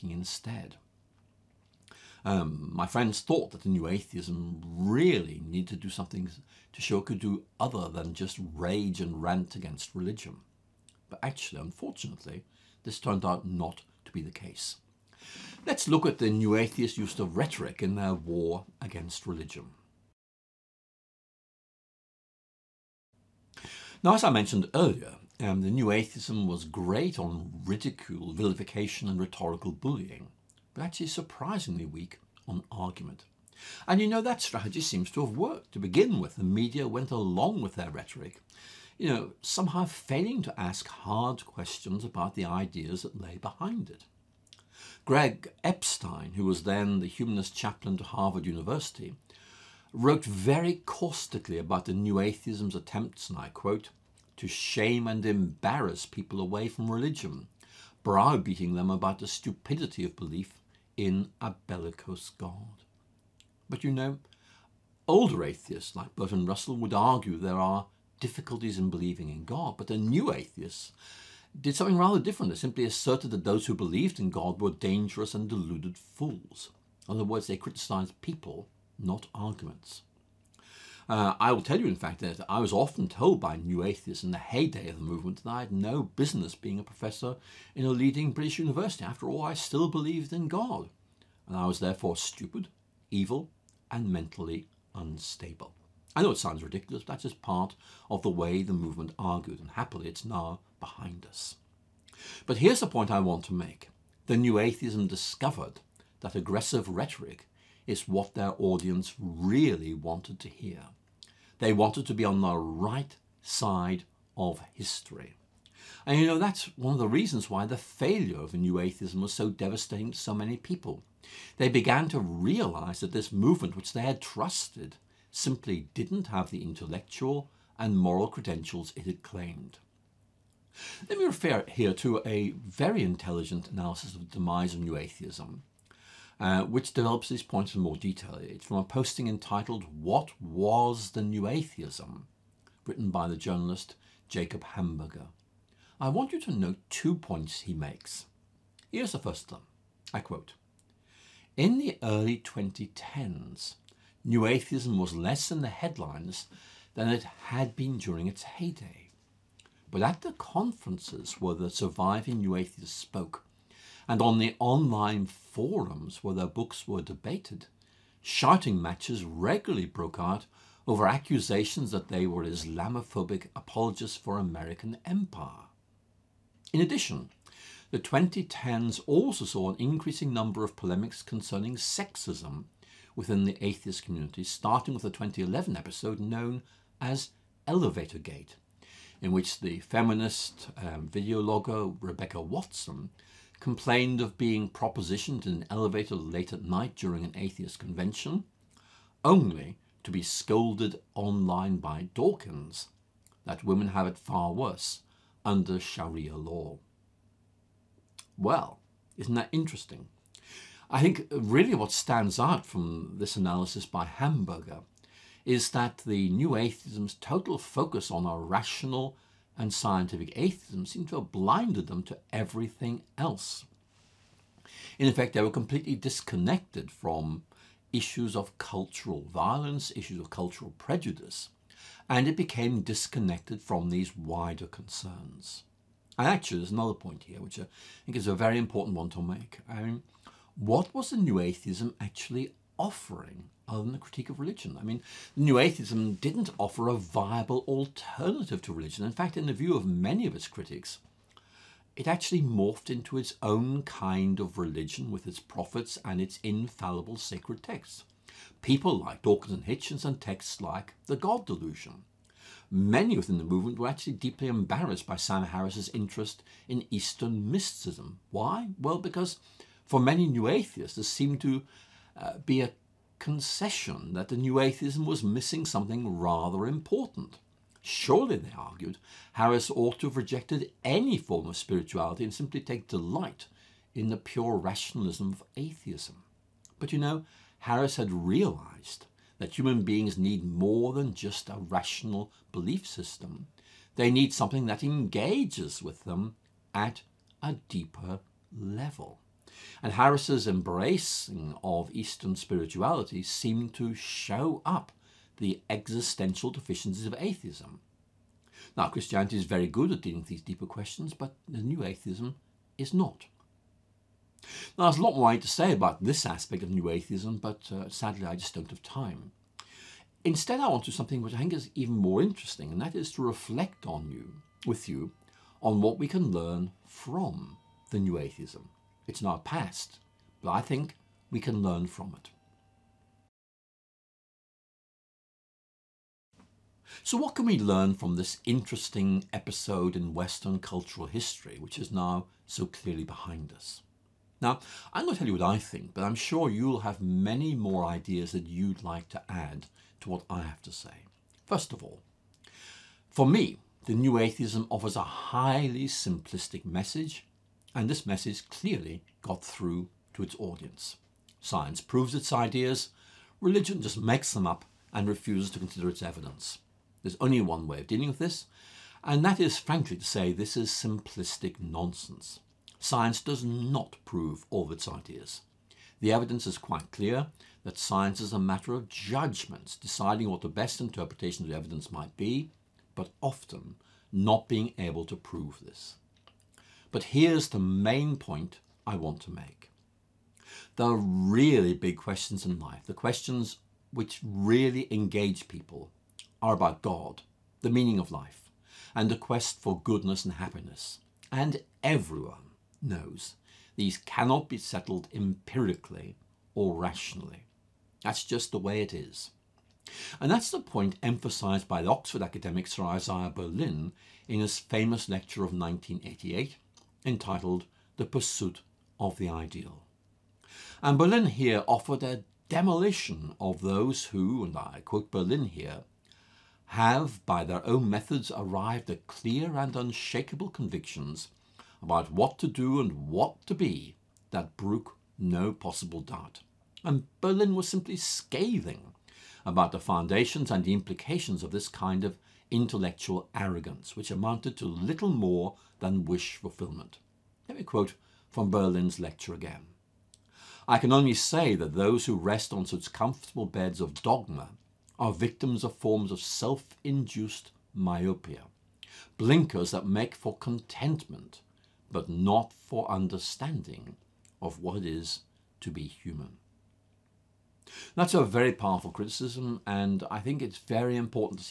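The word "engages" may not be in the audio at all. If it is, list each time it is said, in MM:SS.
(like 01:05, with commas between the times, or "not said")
04:54, 06:34.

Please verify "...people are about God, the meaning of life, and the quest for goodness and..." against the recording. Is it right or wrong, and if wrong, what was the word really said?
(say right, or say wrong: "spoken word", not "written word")
right.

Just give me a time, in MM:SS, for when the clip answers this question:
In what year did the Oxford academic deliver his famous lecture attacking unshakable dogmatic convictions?
06:55.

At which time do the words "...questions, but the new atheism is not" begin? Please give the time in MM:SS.
05:10.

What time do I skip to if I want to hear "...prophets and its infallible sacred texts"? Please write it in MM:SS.
04:15.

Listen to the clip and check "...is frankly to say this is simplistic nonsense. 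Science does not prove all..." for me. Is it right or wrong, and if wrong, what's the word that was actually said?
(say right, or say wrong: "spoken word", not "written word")
right.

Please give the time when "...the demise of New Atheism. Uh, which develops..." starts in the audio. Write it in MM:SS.
02:14.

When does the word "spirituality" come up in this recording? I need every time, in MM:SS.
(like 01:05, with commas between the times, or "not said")
04:41, 05:02.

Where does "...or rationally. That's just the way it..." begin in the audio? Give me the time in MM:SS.
06:46.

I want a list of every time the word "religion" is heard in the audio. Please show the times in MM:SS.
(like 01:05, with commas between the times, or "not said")
00:09, 00:19, 00:56, 04:04, 04:08, 04:14, 06:03.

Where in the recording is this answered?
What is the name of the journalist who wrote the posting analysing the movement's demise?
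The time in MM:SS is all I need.
02:24.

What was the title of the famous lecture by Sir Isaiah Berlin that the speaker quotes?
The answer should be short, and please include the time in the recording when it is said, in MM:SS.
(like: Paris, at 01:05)
The Pursuit of the Ideal, at 06:57.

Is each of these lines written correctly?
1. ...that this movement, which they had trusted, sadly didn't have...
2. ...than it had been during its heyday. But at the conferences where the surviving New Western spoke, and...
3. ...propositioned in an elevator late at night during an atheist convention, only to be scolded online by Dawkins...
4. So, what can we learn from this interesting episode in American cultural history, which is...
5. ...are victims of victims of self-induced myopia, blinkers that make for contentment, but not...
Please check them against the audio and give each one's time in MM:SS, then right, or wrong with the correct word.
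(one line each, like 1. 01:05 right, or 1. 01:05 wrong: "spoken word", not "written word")
1. 02:02 wrong: "simply", not "sadly"
2. 02:36 wrong: "Atheists", not "Western"
3. 03:14 right
4. 05:37 wrong: "Western", not "American"
5. 07:34 wrong: "forms", not "victims".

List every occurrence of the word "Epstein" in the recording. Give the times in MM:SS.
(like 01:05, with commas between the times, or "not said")
00:45.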